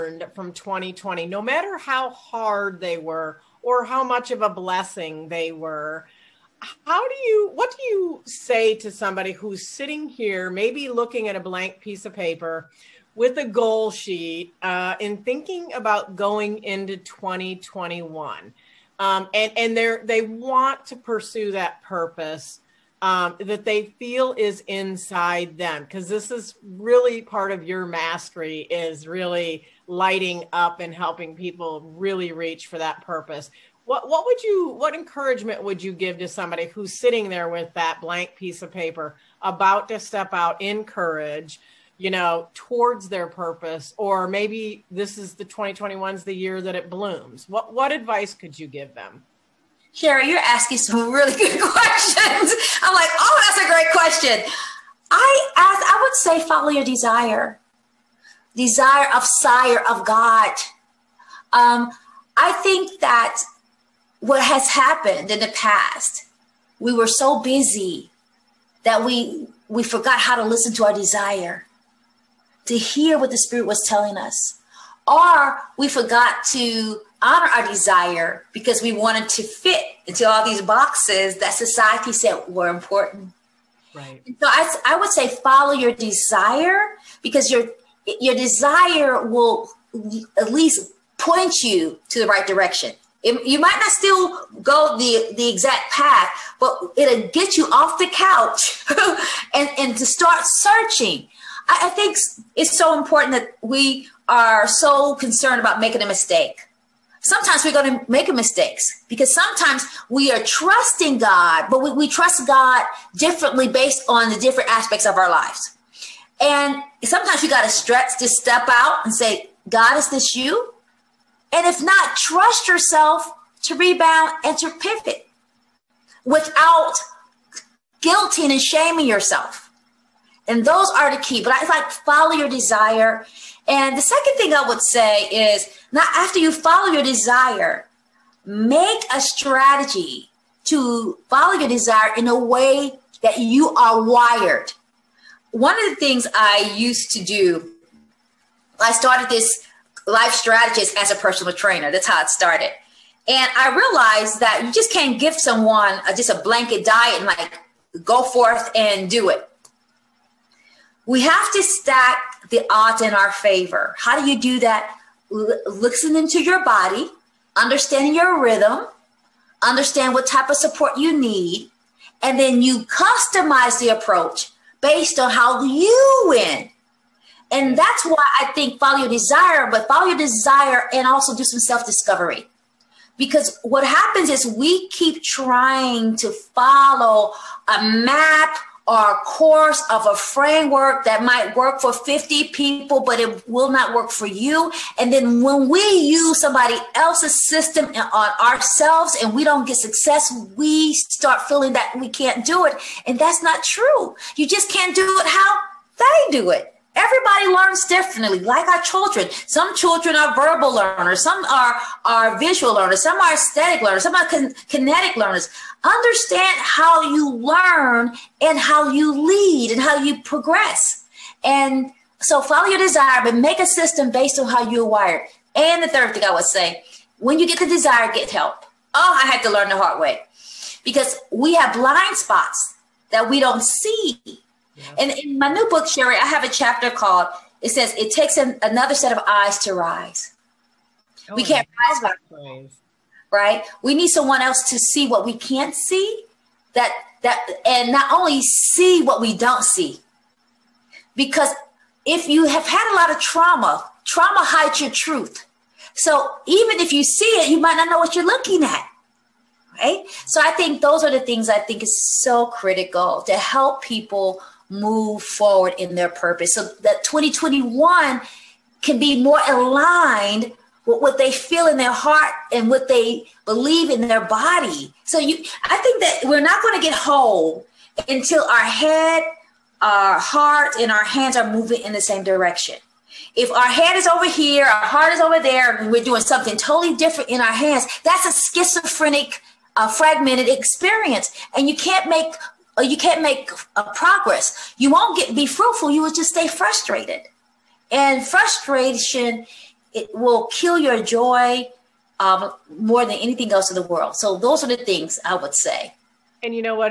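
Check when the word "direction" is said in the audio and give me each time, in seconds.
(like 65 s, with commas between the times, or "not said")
92 s, 282 s.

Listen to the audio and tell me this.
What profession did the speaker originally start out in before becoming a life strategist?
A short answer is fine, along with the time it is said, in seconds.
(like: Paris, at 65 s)
Personal trainer, at 151 s.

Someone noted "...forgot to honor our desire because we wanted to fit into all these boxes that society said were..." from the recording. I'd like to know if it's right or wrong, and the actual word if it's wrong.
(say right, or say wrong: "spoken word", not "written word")
right.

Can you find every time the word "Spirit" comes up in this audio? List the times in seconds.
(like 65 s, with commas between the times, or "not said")
73 s.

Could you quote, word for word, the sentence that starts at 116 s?
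And sometimes you got to stretch to step out and say, God, is this you?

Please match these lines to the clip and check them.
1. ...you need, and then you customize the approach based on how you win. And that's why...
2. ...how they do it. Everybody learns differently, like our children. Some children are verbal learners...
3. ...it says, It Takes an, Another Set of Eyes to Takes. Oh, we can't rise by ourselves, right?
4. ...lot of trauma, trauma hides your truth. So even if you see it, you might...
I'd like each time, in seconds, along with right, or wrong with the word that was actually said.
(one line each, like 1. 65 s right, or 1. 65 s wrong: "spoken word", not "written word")
1. 170 s right
2. 205 s right
3. 237 s wrong: "Rise", not "Takes"
4. 252 s right.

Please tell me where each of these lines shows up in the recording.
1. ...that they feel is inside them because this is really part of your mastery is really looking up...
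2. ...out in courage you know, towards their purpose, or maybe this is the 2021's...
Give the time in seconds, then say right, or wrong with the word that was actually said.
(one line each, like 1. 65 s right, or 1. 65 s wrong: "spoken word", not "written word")
1. 23 s wrong: "lighting", not "looking"
2. 40 s right.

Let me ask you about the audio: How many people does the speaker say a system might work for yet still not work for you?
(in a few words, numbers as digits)
50.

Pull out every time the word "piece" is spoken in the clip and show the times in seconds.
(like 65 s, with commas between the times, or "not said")
11 s, 38 s.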